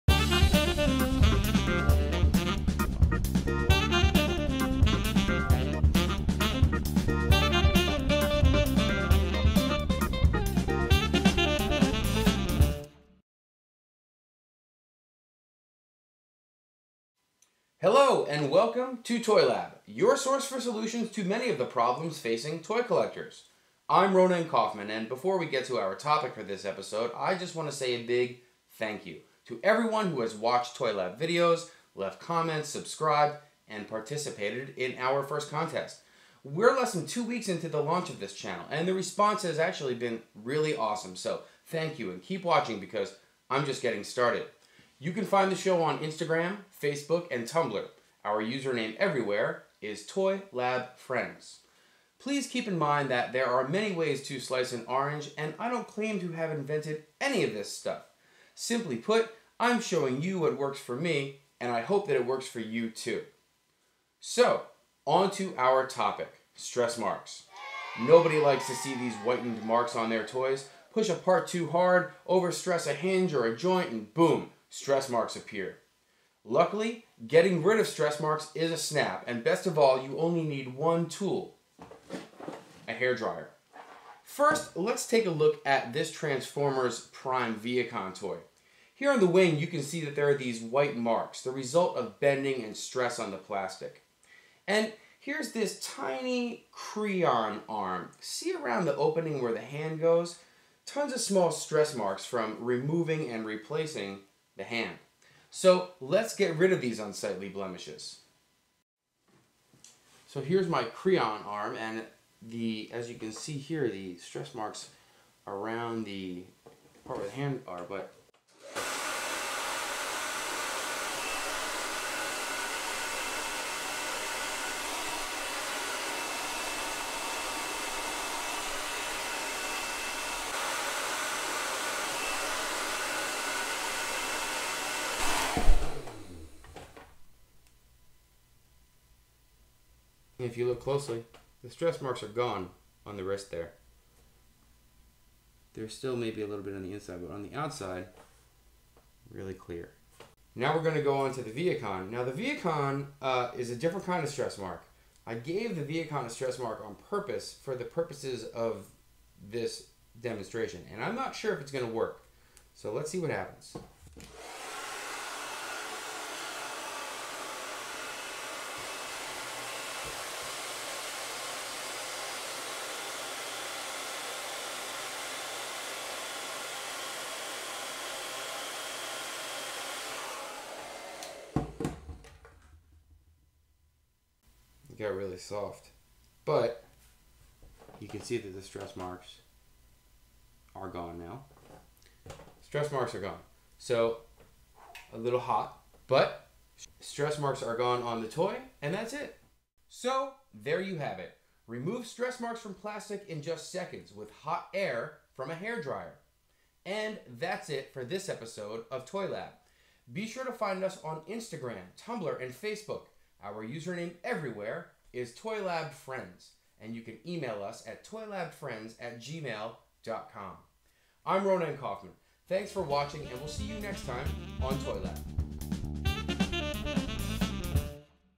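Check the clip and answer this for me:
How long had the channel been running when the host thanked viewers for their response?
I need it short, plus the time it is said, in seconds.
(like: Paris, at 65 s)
Less than two weeks, at 36 s.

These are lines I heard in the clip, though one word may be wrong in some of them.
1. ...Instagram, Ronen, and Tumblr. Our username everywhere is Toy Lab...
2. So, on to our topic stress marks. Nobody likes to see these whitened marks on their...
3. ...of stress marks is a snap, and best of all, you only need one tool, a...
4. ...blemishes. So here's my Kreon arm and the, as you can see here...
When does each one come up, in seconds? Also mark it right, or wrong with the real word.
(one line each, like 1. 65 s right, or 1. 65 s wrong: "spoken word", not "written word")
1. 45 s wrong: "Facebook", not "Ronen"
2. 64 s right
3. 77 s right
4. 107 s right.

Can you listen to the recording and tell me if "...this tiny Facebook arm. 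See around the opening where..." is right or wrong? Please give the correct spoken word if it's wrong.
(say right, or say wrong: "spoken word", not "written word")
wrong: "Kreon", not "Facebook".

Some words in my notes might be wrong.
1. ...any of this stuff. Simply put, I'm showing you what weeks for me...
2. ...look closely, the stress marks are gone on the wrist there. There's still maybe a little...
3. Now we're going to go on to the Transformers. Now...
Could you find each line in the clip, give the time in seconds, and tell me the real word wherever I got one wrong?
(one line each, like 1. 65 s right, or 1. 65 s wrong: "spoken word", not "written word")
1. 57 s wrong: "works", not "weeks"
2. 140 s right
3. 150 s wrong: "Vehicon", not "Transformers".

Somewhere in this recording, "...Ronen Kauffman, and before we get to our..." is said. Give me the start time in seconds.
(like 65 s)
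24 s.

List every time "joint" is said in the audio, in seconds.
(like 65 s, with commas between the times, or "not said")
73 s.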